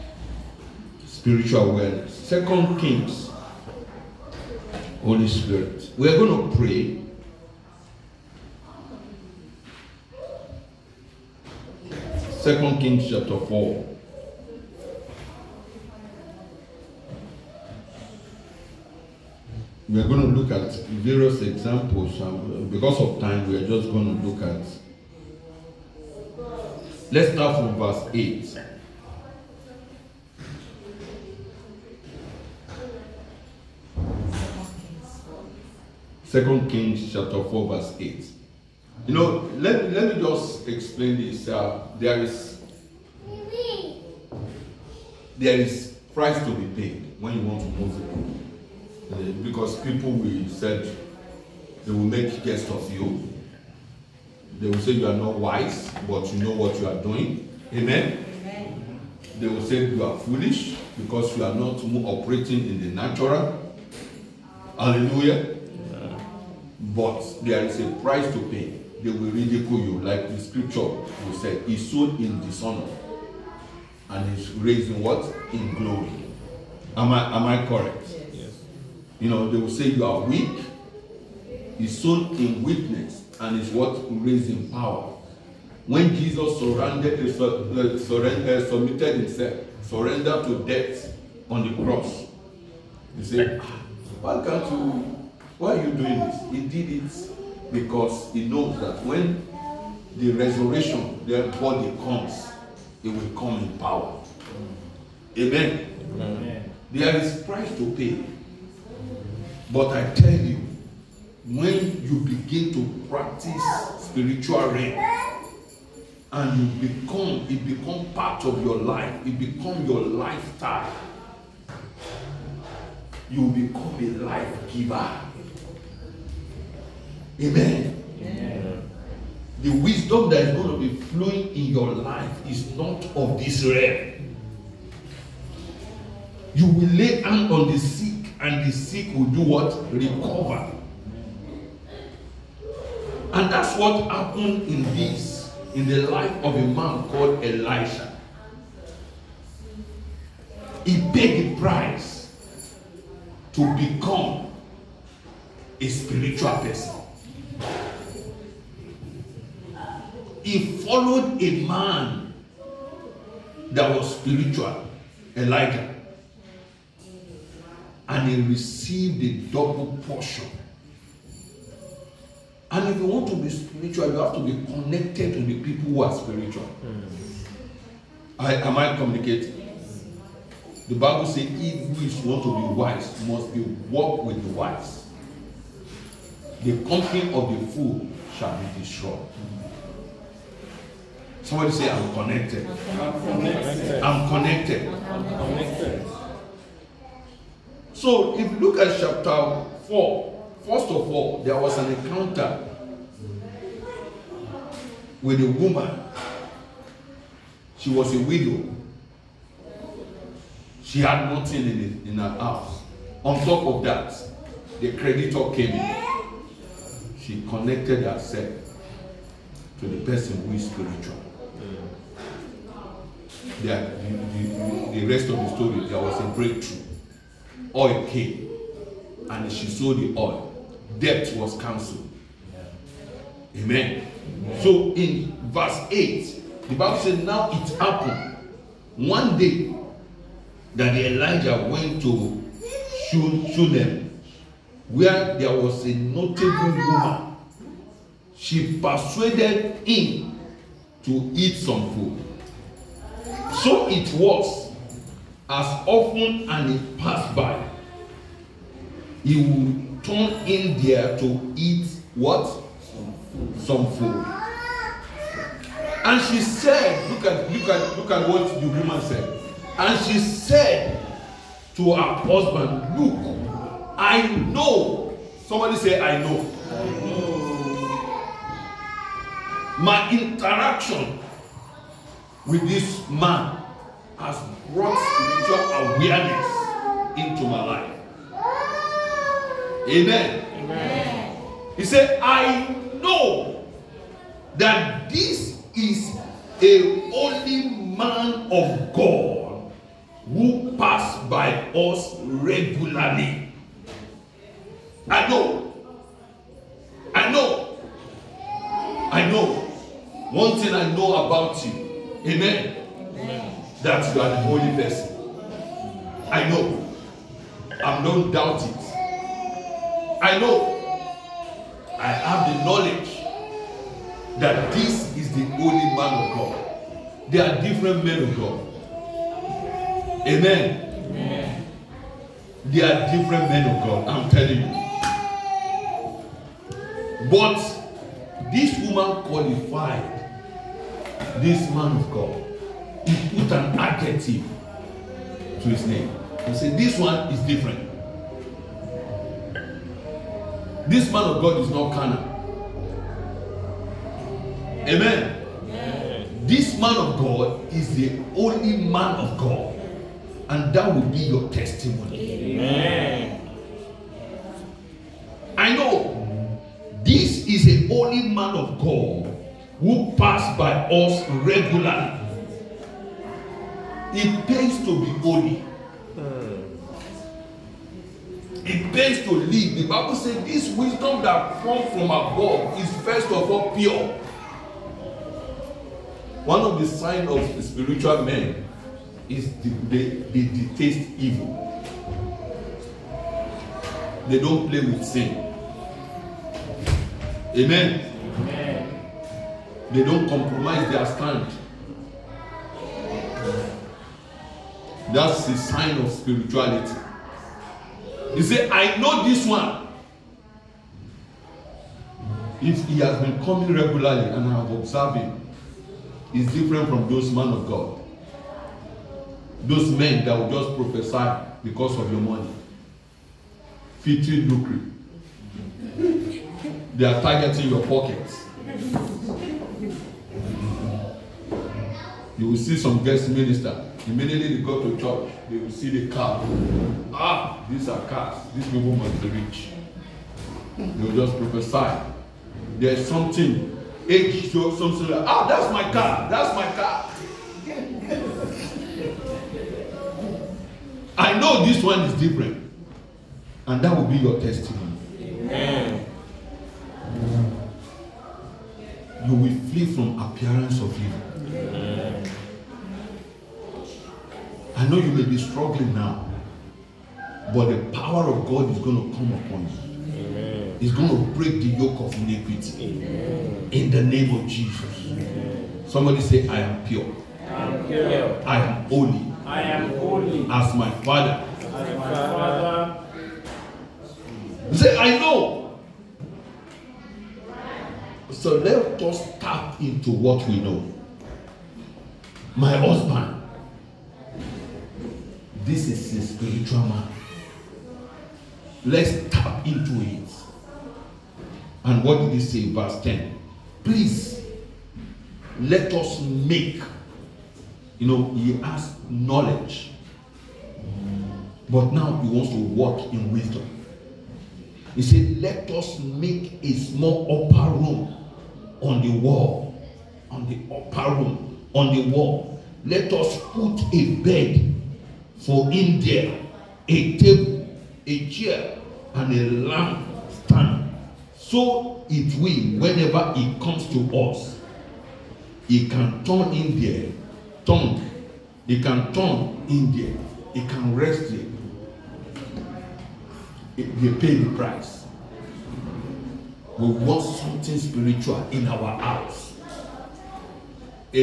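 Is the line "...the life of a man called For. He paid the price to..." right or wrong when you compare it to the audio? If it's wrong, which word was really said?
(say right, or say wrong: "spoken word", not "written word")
wrong: "Elisha", not "For".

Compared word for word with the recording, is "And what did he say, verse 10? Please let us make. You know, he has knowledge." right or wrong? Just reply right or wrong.
right.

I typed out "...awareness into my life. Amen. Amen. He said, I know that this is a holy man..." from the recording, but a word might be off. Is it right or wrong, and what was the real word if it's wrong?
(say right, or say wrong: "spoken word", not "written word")
right.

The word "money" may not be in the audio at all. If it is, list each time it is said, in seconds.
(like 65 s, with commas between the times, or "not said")
422 s.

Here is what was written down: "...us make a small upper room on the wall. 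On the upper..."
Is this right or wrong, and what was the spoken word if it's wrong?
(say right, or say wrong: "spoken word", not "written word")
right.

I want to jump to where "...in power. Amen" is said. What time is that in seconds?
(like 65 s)
103 s.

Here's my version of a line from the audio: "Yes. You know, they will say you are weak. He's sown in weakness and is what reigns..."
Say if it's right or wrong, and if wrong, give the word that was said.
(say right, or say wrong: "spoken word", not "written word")
right.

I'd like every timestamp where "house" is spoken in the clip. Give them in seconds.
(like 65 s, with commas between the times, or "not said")
212 s, 549 s.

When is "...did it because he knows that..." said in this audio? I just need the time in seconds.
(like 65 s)
96 s.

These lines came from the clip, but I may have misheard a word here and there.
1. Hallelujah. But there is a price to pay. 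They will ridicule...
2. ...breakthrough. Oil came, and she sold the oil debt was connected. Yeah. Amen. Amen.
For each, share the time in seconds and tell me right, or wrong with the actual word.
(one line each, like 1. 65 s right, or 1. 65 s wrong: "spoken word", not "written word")
1. 64 s right
2. 226 s wrong: "cancelled", not "connected".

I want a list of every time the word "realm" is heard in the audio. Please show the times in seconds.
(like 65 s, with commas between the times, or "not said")
133 s.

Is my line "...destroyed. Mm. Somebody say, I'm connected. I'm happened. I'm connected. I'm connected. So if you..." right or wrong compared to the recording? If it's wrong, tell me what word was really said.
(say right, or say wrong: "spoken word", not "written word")
wrong: "connected", not "happened".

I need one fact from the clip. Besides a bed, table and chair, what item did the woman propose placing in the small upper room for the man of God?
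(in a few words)
A lamp stand.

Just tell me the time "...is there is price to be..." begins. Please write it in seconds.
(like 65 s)
42 s.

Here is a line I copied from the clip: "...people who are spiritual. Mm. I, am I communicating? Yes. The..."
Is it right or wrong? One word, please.
right.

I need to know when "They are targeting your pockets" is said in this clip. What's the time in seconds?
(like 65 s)
426 s.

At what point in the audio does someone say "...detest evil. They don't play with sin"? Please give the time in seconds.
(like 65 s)
390 s.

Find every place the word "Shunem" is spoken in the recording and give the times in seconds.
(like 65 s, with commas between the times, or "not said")
243 s.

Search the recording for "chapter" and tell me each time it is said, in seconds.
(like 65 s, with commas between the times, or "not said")
13 s, 37 s, 198 s.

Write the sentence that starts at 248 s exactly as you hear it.
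She persuaded him to eat some food.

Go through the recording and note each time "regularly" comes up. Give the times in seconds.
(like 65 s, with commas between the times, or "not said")
302 s, 371 s, 413 s.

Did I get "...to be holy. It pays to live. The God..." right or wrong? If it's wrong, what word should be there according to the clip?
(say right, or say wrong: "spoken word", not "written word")
wrong: "Bible", not "God".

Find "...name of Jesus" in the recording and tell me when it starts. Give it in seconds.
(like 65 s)
474 s.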